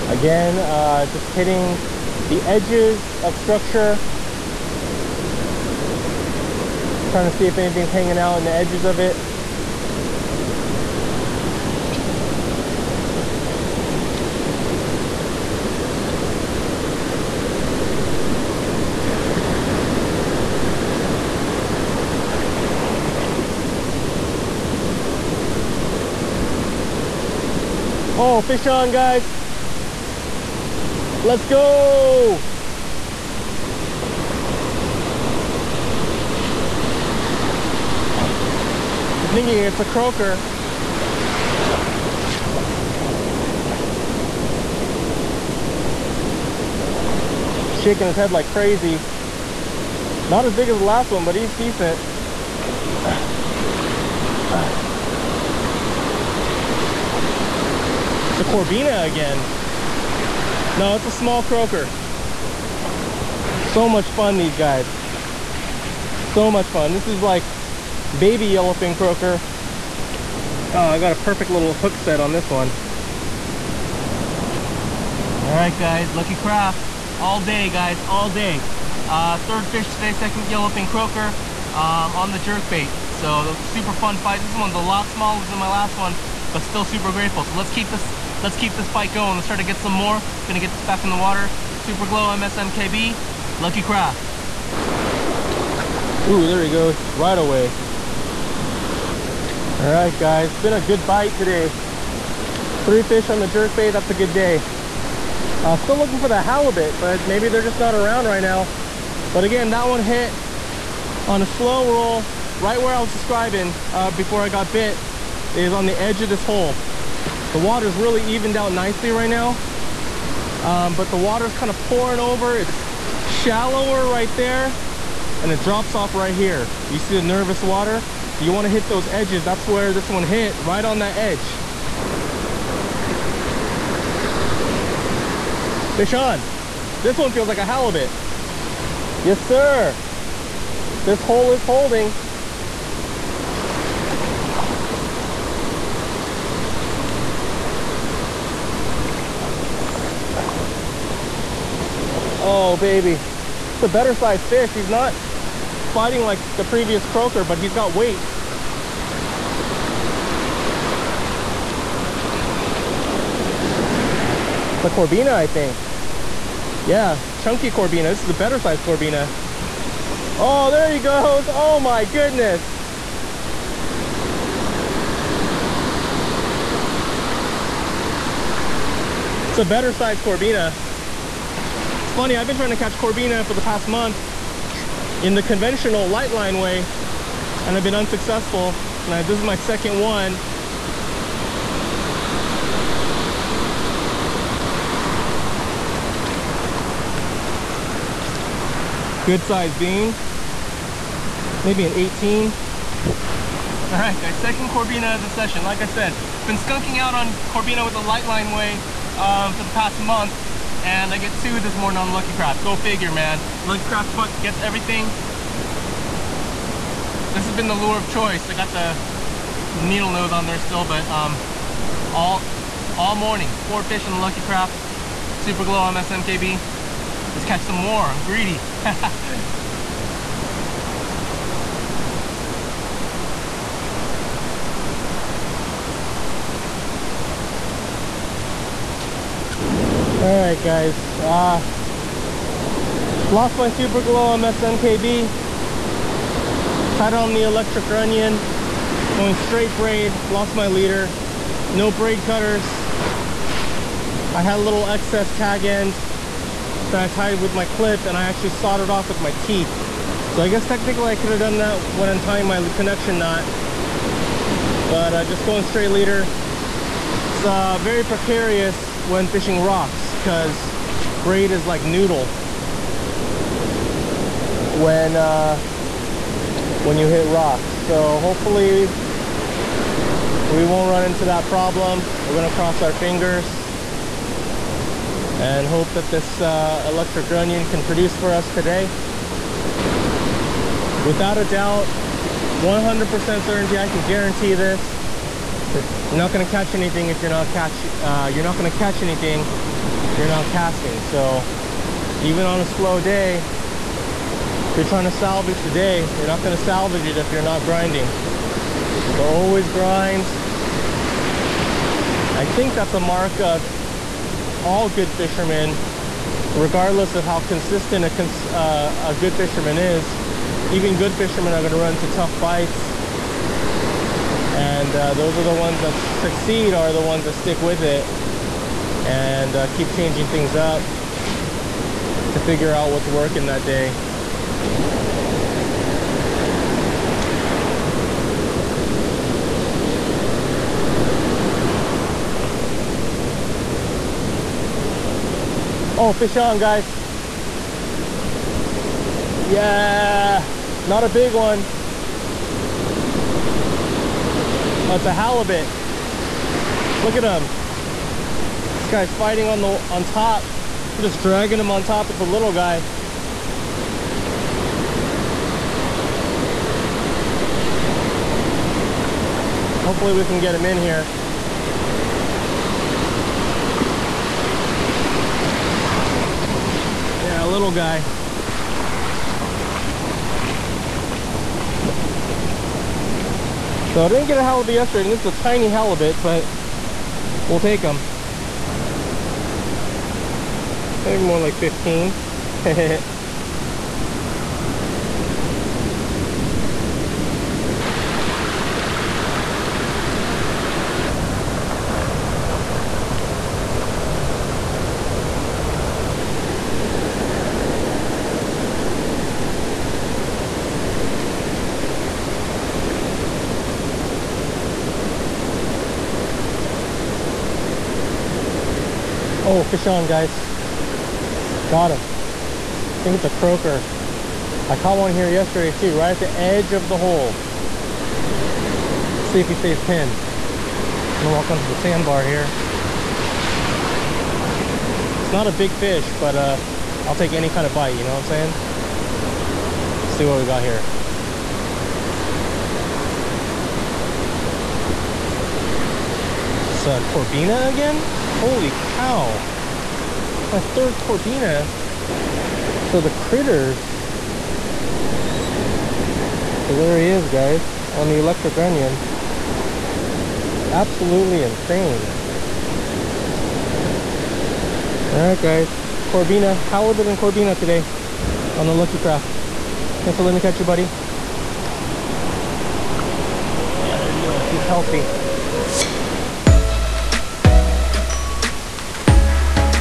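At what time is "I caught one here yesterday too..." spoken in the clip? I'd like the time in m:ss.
7:04.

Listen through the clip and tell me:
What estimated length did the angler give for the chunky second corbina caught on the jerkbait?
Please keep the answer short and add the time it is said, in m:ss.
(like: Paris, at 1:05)
18, at 3:21.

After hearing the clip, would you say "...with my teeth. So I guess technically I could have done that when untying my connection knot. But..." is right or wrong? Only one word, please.
right.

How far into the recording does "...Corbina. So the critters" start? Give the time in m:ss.
7:30.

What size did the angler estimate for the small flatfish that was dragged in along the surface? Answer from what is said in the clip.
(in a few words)
15.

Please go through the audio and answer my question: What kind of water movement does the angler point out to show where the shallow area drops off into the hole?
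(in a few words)
nervous water.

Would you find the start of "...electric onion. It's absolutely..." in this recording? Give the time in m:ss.
7:38.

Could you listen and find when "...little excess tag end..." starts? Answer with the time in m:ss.
4:14.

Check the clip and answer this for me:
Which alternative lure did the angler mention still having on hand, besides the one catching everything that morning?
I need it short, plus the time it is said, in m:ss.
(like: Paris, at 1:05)
needle nose, at 3:39.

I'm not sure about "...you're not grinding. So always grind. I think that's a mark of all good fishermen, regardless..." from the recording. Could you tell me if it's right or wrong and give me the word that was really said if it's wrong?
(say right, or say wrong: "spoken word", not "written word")
right.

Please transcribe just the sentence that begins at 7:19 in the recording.
Let's see what we got here.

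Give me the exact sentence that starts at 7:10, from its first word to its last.
I'm gonna walk onto the sandbar here.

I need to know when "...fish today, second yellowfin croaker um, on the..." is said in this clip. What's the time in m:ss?
1:19.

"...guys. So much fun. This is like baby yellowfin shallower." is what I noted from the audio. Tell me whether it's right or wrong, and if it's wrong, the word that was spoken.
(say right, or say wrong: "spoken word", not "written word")
wrong: "croaker", not "shallower".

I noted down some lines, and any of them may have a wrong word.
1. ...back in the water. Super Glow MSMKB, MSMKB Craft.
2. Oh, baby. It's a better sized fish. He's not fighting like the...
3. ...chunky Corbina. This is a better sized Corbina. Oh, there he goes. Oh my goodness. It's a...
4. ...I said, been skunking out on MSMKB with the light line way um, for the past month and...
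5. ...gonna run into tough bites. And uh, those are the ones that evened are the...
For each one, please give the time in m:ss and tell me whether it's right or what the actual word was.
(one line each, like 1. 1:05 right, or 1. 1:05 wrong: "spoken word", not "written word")
1. 1:30 wrong: "Lucky", not "MSMKB"
2. 2:32 right
3. 2:47 right
4. 3:25 wrong: "Corbina", not "MSMKB"
5. 5:21 wrong: "succeed", not "evened".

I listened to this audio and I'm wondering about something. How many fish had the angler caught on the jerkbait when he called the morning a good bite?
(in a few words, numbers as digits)
3.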